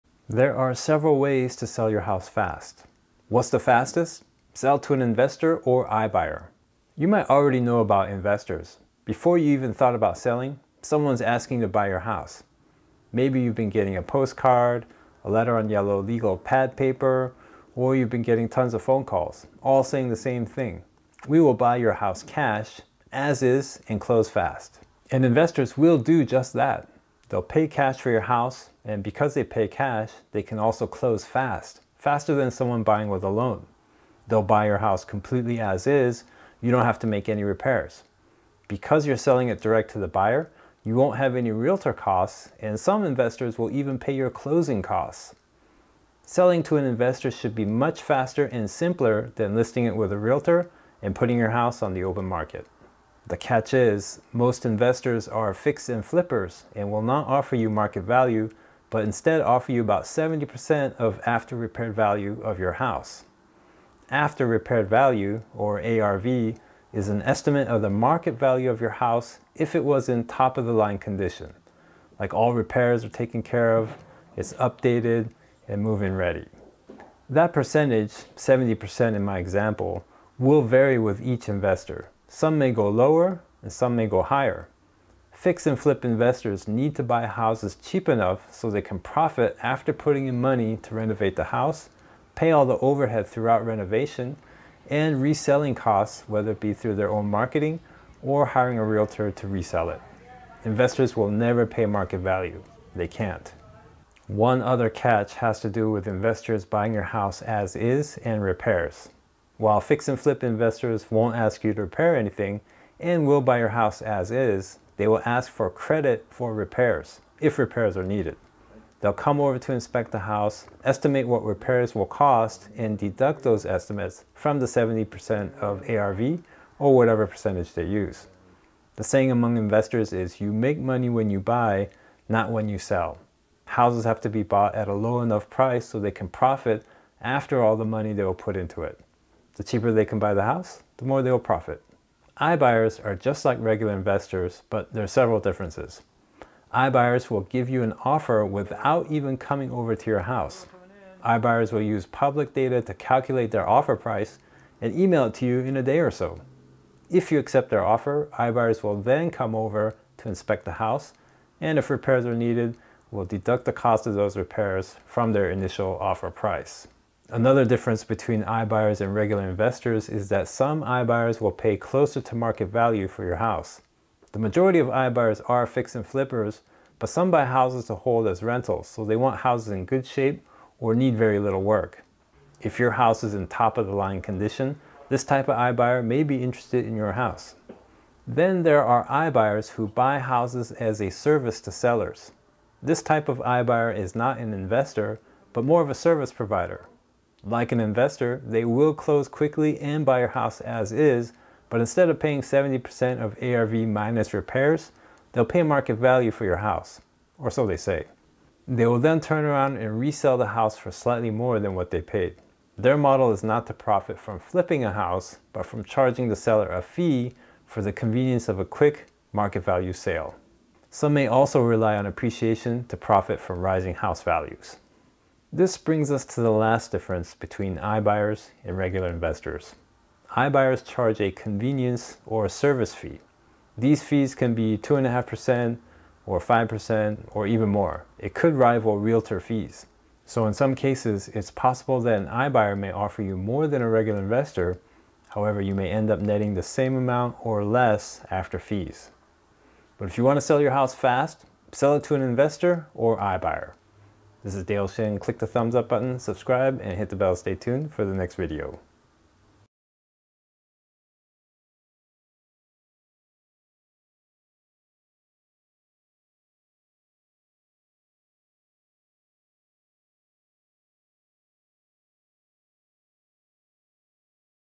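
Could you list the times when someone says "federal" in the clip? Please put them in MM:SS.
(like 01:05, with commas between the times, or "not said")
not said.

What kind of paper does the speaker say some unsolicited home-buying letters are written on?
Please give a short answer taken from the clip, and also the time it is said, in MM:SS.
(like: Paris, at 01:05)
yellow legal pad paper, at 00:15.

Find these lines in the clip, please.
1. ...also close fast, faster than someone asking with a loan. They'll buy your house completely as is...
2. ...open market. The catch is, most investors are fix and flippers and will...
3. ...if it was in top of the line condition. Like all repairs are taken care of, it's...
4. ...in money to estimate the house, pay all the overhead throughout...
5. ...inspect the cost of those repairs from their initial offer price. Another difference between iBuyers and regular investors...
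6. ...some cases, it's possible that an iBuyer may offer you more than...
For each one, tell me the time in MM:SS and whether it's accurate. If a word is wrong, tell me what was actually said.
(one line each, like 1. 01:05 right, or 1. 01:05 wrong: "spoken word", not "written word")
1. 00:30 wrong: "buying", not "asking"
2. 00:52 right
3. 01:09 right
4. 01:30 wrong: "renovate", not "estimate"
5. 02:43 wrong: "deduct", not "inspect"
6. 04:00 right.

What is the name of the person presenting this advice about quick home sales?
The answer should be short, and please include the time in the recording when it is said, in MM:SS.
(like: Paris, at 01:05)
Dale Shin, at 04:14.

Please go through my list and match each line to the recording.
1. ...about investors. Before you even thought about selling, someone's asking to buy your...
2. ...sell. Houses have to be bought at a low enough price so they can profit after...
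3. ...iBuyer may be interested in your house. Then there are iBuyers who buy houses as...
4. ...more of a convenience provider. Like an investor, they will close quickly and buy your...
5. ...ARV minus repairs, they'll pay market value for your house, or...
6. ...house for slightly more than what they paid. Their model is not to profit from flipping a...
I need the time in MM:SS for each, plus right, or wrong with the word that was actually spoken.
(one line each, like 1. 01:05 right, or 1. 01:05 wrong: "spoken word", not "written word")
1. 00:07 right
2. 02:12 right
3. 03:05 right
4. 03:15 wrong: "service", not "convenience"
5. 03:23 right
6. 03:30 right.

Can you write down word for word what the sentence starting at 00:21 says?
We will buy your house cash, as is, and close fast.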